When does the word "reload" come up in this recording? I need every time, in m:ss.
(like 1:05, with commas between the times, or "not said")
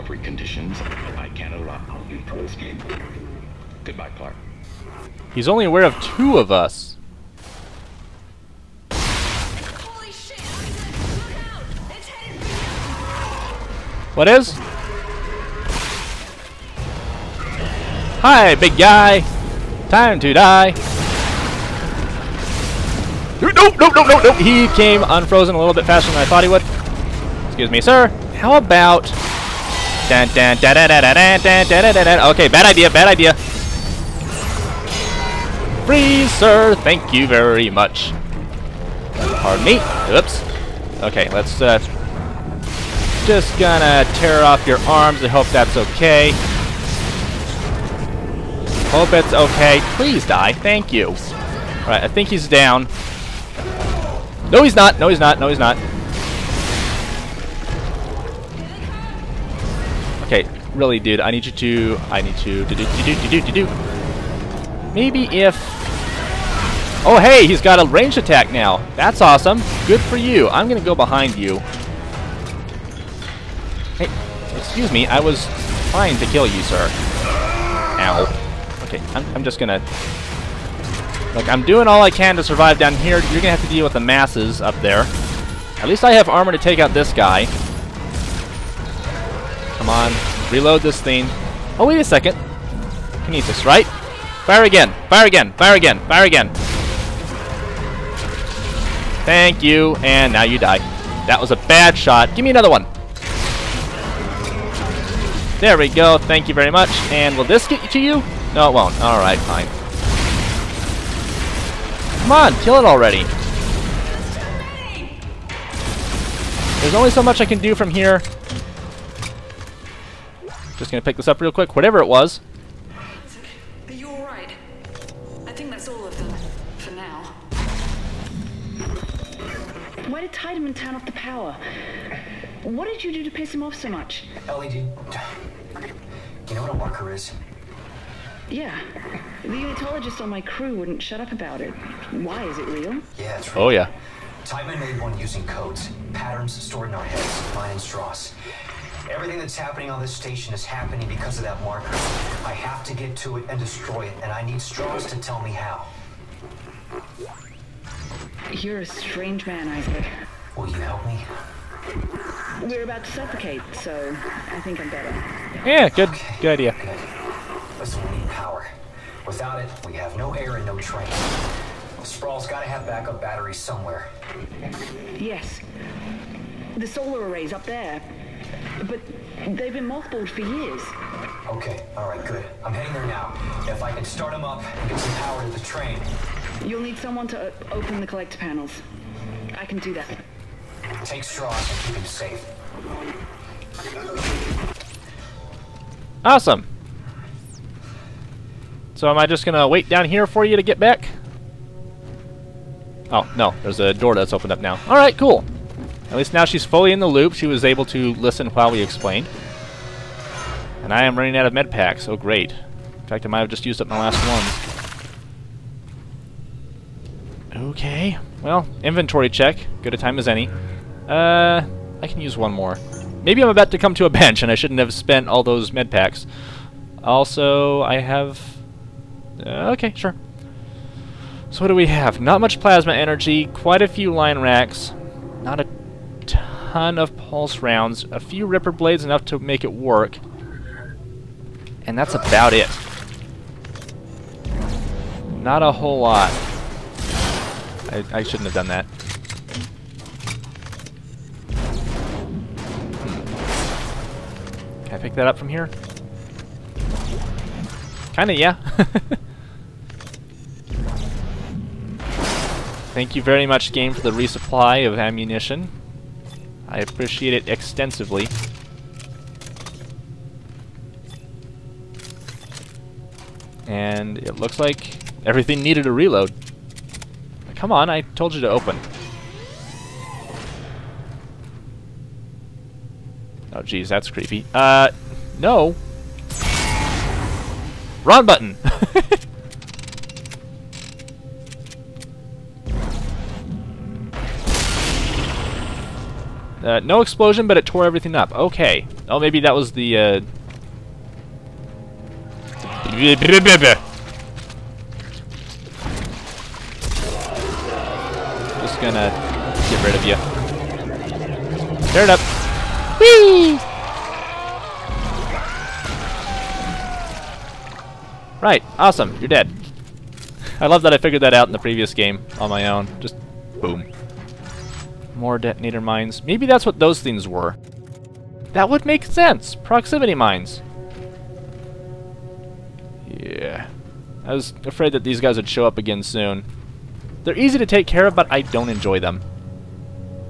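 1:30, 4:35.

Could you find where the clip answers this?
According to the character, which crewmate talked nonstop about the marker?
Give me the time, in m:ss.
2:19.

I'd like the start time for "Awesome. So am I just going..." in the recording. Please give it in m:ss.
3:16.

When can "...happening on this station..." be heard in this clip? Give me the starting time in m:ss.
2:29.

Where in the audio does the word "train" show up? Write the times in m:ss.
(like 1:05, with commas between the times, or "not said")
2:50, 3:05.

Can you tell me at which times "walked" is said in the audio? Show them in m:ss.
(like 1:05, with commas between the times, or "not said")
not said.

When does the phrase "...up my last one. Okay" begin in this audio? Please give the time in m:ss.
3:33.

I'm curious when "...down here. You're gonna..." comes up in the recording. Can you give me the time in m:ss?
1:22.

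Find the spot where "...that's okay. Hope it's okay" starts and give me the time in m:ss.
0:45.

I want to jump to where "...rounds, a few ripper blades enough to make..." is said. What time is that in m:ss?
3:57.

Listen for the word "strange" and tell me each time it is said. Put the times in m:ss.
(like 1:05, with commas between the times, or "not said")
2:38.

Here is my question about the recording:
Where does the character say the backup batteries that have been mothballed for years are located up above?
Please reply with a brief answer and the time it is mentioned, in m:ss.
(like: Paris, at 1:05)
The solar array, at 2:56.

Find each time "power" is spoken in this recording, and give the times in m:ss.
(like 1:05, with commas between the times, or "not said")
2:11, 3:05.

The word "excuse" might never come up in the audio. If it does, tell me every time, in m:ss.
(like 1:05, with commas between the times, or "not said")
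0:27, 1:14.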